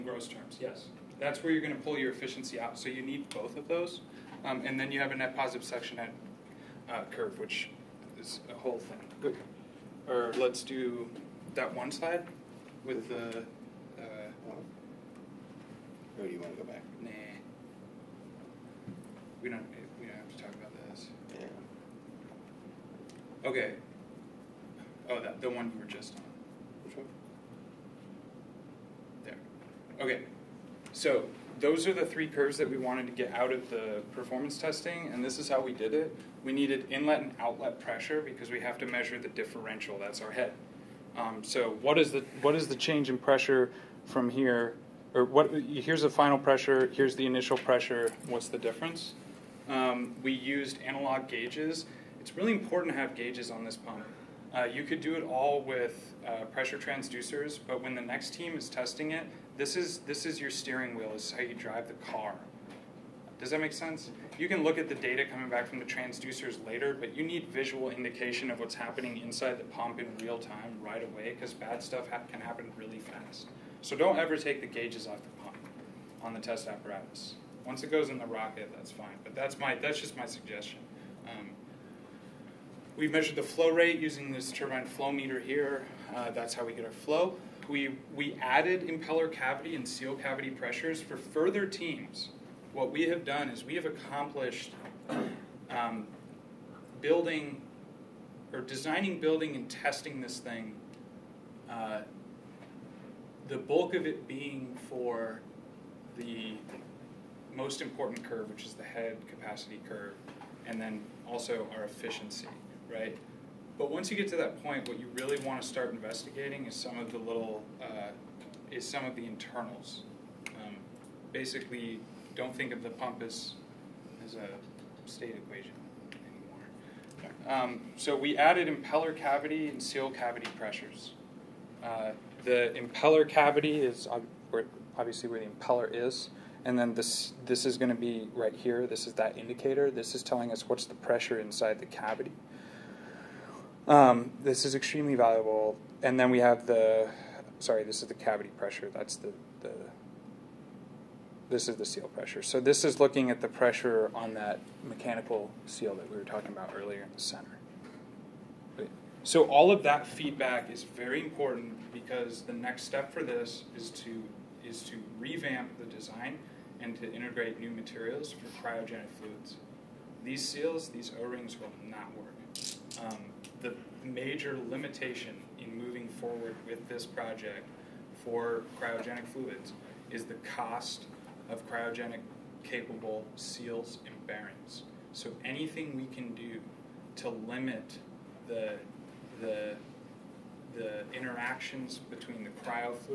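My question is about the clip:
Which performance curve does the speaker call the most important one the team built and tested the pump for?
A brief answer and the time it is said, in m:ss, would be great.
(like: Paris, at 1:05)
head capacity curve, at 1:48.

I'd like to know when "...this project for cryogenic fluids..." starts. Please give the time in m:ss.
2:56.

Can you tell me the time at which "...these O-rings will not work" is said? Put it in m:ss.
2:50.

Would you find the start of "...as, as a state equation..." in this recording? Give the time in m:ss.
2:03.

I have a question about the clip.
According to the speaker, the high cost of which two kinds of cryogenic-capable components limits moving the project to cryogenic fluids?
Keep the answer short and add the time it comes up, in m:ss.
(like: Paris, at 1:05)
seals and bearings, at 3:03.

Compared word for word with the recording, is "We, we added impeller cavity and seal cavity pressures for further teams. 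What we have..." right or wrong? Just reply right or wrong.
right.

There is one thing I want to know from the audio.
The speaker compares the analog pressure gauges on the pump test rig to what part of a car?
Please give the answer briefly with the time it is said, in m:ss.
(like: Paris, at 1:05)
steering wheel, at 1:00.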